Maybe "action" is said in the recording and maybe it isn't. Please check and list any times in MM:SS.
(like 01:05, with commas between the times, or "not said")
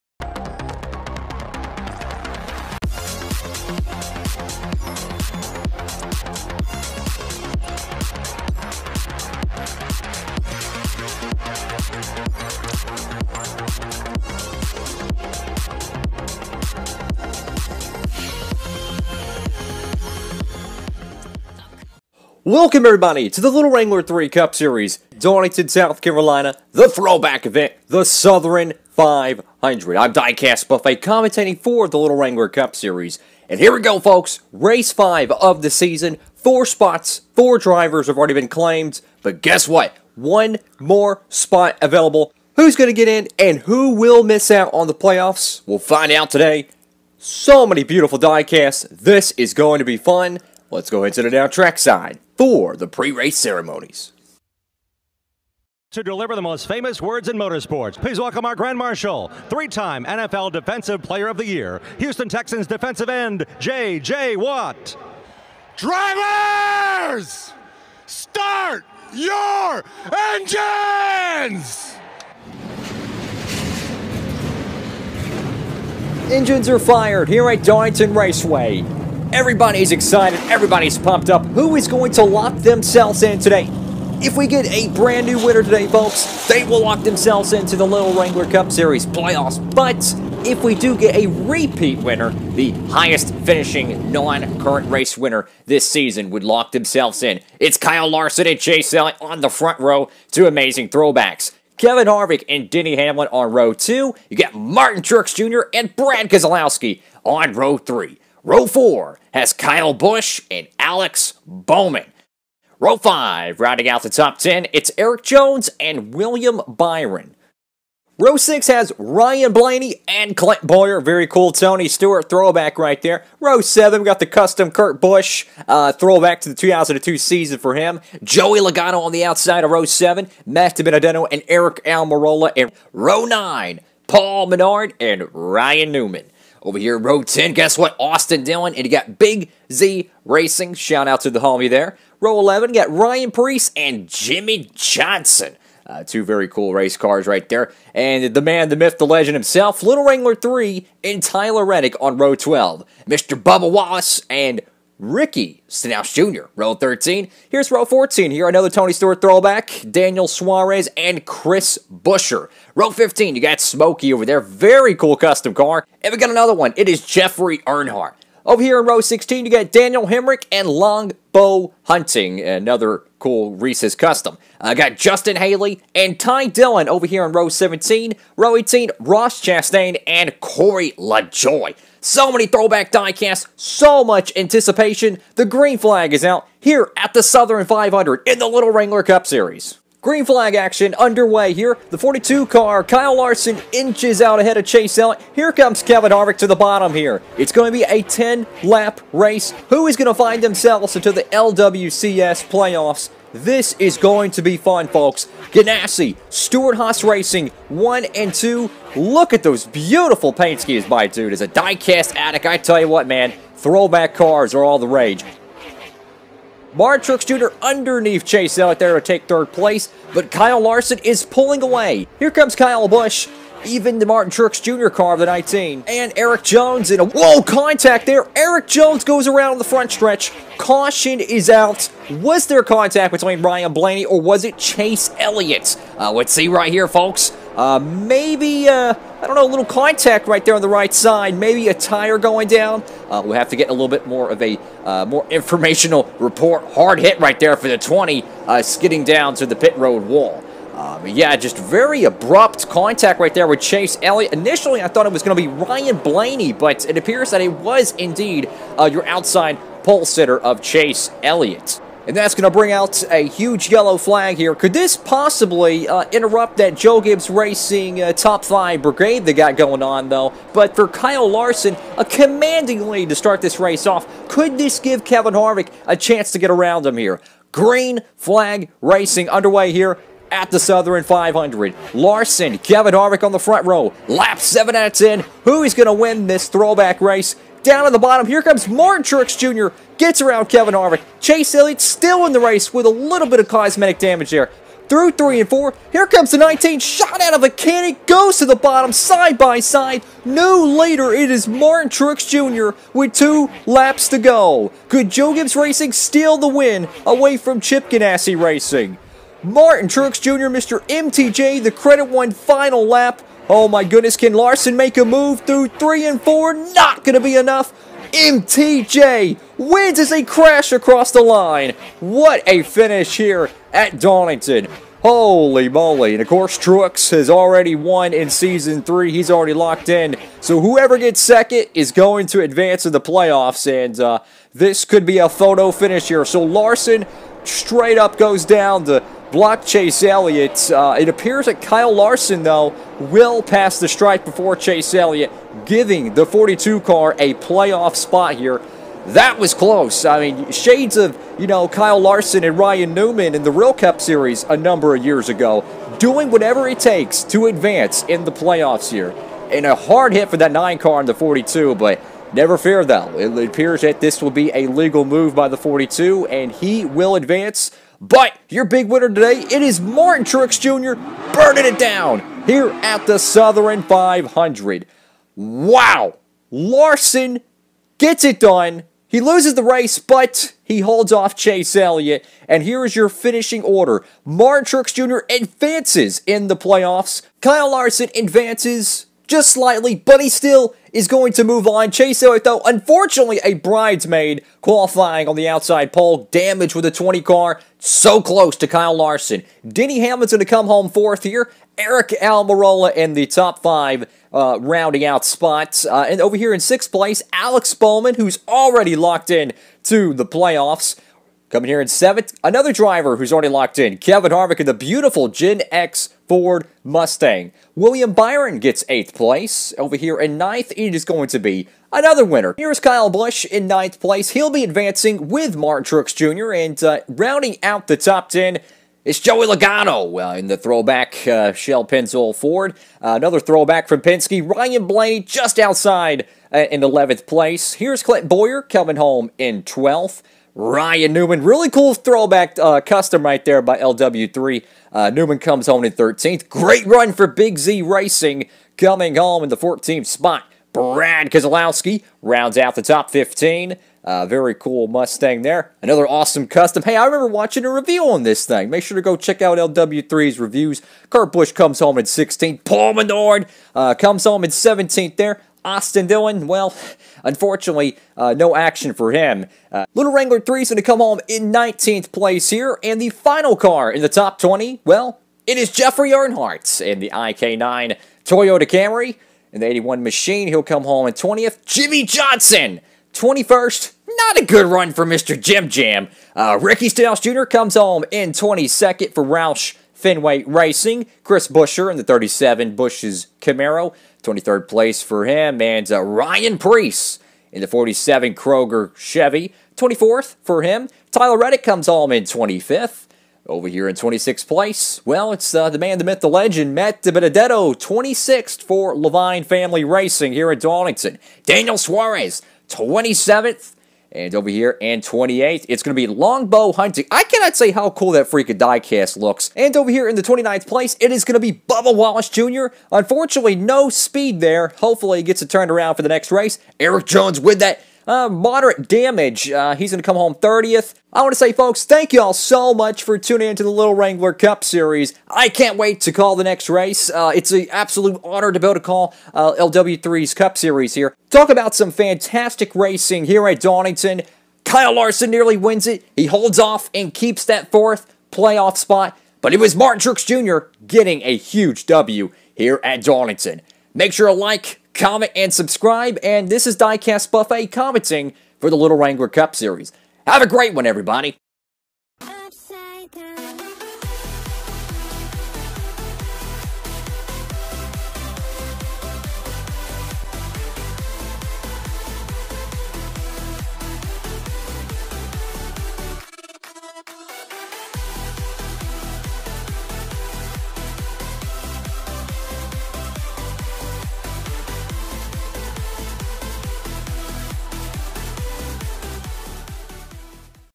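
03:10, 07:48.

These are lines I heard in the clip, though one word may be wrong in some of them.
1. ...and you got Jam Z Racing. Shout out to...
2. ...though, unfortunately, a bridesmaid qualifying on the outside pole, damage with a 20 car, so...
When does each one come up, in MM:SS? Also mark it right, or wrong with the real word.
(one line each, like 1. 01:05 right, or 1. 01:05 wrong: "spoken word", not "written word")
1. 02:18 wrong: "Big", not "Jam"
2. 06:32 right.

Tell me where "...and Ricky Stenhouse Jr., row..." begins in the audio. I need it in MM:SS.
02:34.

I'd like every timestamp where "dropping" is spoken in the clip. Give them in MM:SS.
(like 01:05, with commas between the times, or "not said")
not said.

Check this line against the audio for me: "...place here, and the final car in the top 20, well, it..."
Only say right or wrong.
right.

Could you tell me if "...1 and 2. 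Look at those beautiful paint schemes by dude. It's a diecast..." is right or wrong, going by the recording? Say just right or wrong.
right.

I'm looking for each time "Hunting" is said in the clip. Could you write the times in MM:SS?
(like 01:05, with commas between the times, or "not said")
02:51, 08:36.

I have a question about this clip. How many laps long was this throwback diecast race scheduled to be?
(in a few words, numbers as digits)
10.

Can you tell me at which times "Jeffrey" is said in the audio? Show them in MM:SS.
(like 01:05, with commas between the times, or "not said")
02:47, 07:55.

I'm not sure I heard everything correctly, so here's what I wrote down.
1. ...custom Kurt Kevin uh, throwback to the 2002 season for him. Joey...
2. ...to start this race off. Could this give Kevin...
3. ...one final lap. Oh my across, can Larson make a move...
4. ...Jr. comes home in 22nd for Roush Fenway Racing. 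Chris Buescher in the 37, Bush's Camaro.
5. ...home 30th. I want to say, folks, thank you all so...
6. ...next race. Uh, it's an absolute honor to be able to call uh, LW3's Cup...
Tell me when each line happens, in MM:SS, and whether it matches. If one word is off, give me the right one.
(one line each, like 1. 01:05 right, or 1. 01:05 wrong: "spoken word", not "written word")
1. 02:04 wrong: "Busch", not "Kevin"
2. 04:33 right
3. 05:12 wrong: "goodness", not "across"
4. 08:07 right
5. 08:50 right
6. 08:56 right.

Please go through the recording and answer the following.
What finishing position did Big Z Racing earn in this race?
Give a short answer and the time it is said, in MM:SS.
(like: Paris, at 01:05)
14th, at 07:29.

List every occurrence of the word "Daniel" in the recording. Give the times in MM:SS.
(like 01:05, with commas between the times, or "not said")
02:39, 02:49, 08:31.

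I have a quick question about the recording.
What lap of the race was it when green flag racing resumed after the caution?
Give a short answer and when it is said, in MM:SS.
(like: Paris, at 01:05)
Lap 7, at 04:44.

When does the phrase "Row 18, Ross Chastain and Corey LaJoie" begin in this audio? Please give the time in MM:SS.
02:58.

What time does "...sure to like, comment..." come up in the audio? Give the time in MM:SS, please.
09:14.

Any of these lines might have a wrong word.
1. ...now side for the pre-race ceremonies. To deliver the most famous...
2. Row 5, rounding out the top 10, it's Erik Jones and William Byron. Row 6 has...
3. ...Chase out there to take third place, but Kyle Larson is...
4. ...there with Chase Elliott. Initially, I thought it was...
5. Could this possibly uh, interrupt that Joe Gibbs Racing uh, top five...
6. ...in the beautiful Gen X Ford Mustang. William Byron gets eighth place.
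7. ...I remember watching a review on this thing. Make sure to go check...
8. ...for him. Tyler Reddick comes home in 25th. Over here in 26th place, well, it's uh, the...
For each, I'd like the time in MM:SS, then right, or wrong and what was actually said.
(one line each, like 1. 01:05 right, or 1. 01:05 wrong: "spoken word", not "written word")
1. 00:51 right
2. 01:52 right
3. 03:38 right
4. 04:13 right
5. 04:24 right
6. 06:54 right
7. 07:36 right
8. 08:20 right.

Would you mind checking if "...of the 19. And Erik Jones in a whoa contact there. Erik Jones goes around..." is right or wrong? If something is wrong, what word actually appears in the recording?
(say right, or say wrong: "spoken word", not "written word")
right.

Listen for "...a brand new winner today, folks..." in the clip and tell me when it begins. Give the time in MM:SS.
01:24.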